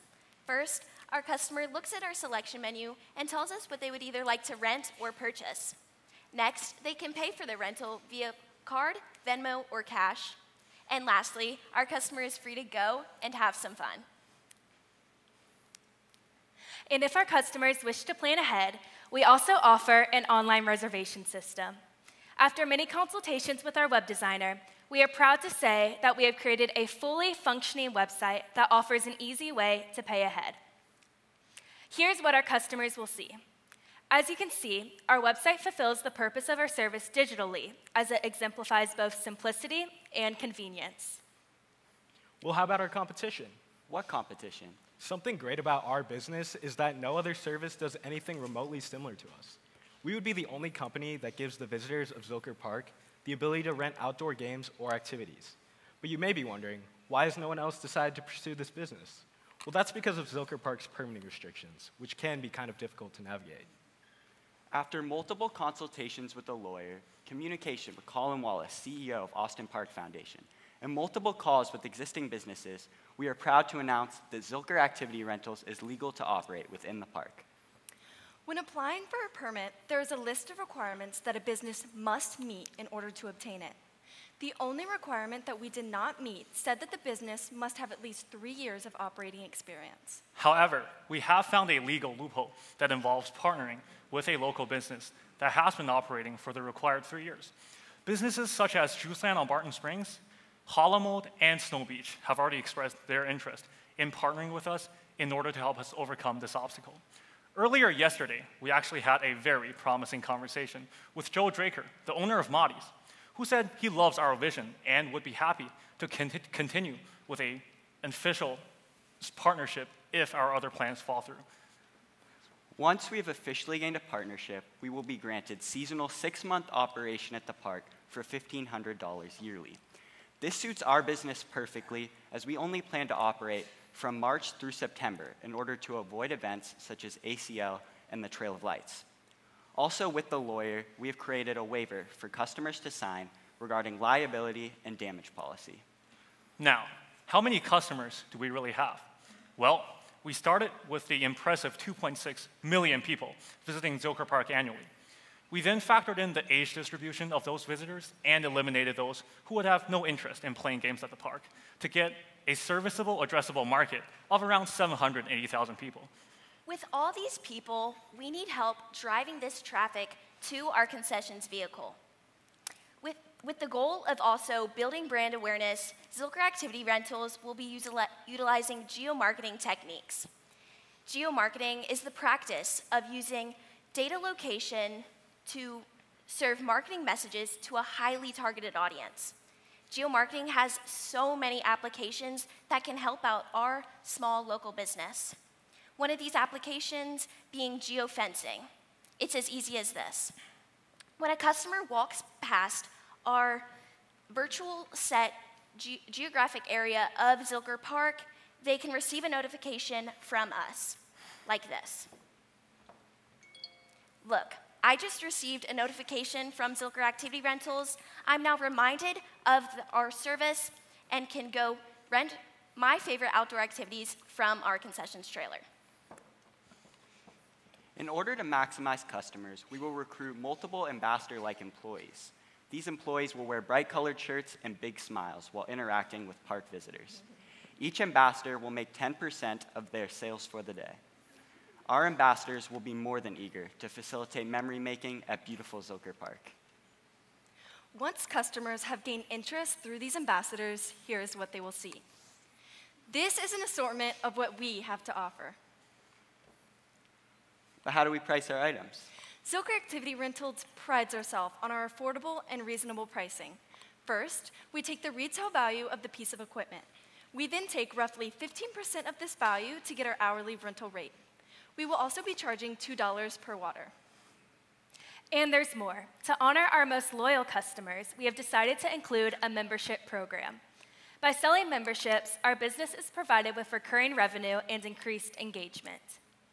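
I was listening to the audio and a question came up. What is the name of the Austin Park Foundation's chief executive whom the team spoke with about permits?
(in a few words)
Colin Wallace.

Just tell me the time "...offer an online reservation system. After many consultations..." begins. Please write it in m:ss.
0:19.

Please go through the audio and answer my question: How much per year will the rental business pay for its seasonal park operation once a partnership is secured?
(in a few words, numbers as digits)
$1,500.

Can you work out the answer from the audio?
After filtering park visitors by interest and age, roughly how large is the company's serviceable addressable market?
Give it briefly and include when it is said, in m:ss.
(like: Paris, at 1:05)
780,000, at 2:44.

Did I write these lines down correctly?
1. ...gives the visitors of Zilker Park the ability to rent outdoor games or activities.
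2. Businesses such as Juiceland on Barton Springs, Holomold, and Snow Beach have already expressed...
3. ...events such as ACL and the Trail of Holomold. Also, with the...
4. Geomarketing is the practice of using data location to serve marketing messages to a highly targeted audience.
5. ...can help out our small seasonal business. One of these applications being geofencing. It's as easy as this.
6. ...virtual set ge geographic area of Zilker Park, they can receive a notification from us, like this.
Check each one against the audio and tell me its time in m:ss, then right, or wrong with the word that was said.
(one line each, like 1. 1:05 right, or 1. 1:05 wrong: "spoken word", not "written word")
1. 0:51 right
2. 1:38 right
3. 2:16 wrong: "Lights", not "Holomold"
4. 3:01 right
5. 3:12 wrong: "local", not "seasonal"
6. 3:24 right.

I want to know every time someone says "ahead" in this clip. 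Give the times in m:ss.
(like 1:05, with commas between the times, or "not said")
0:18, 0:30.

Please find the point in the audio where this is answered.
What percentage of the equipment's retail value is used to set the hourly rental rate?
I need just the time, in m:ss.
4:28.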